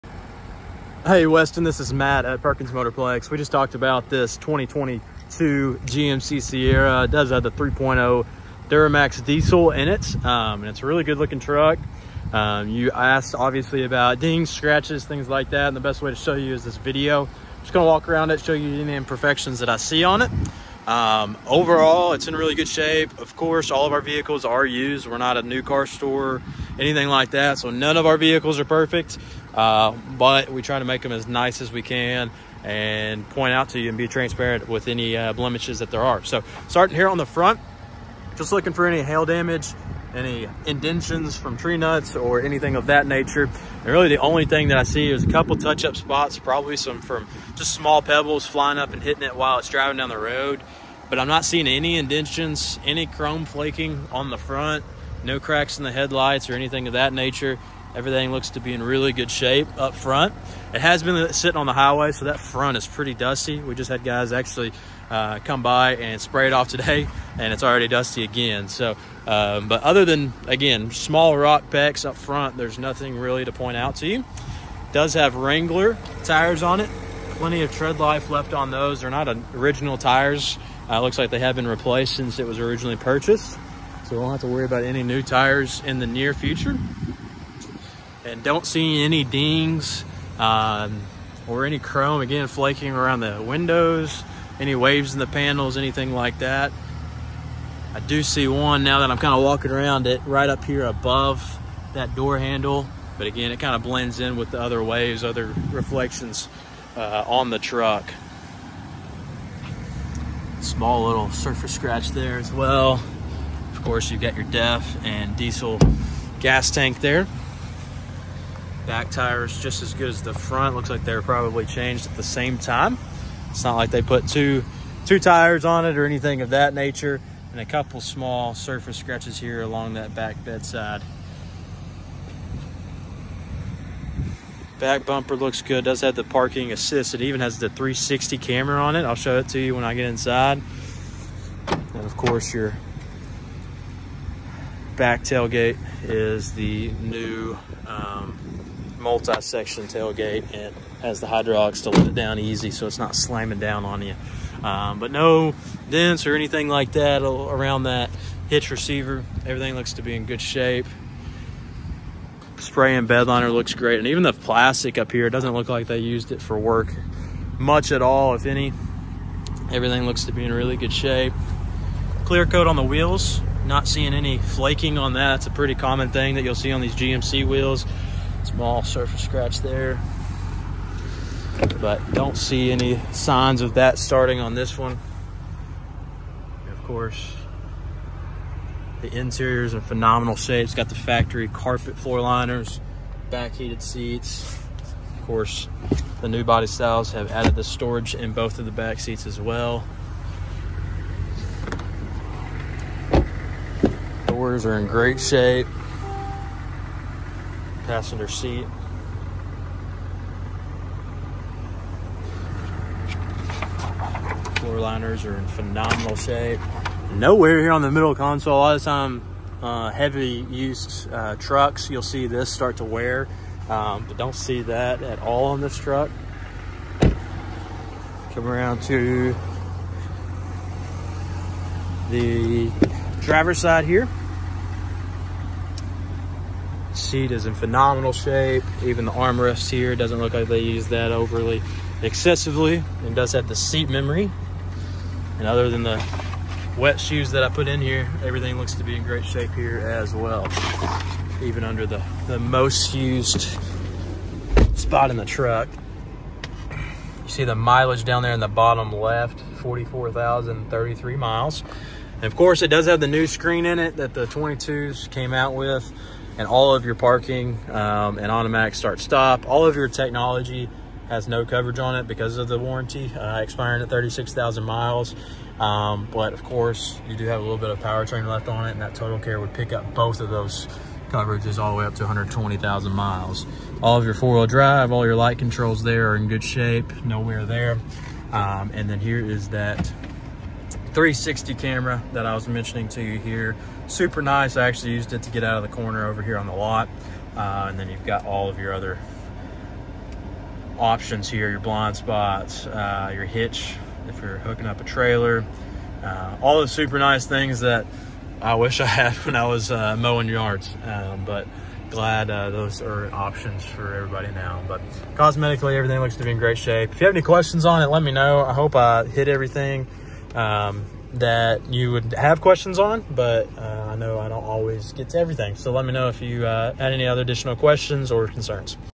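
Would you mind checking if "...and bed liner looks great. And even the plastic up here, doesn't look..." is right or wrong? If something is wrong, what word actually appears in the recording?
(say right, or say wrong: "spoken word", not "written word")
right.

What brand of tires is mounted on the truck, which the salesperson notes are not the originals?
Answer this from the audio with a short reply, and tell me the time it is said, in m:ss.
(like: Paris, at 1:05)
Wrangler, at 1:15.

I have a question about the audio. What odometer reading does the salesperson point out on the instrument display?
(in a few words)
44,033 miles.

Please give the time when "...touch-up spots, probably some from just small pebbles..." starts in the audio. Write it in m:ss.
0:45.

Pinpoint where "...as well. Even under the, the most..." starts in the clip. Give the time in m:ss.
4:09.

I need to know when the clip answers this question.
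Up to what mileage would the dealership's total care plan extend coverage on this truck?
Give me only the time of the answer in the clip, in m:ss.
4:42.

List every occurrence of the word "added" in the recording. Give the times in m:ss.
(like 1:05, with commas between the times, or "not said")
3:17.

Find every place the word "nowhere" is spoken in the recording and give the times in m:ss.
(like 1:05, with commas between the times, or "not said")
3:37, 4:47.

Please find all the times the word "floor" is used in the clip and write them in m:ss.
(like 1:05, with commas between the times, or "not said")
3:11, 3:34.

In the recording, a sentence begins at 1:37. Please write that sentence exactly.
I do see one now that I'm kind of walking around it right up here above that door handle.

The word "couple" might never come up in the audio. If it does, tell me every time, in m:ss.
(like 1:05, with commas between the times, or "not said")
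0:45, 2:07.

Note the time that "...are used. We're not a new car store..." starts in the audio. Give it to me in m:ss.
0:24.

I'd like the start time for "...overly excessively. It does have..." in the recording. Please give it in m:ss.
4:01.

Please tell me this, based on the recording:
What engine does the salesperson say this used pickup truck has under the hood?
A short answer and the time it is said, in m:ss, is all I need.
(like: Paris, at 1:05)
3.0 Duramax diesel, at 0:07.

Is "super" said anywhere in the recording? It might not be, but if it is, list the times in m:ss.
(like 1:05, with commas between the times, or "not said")
4:53, 5:06.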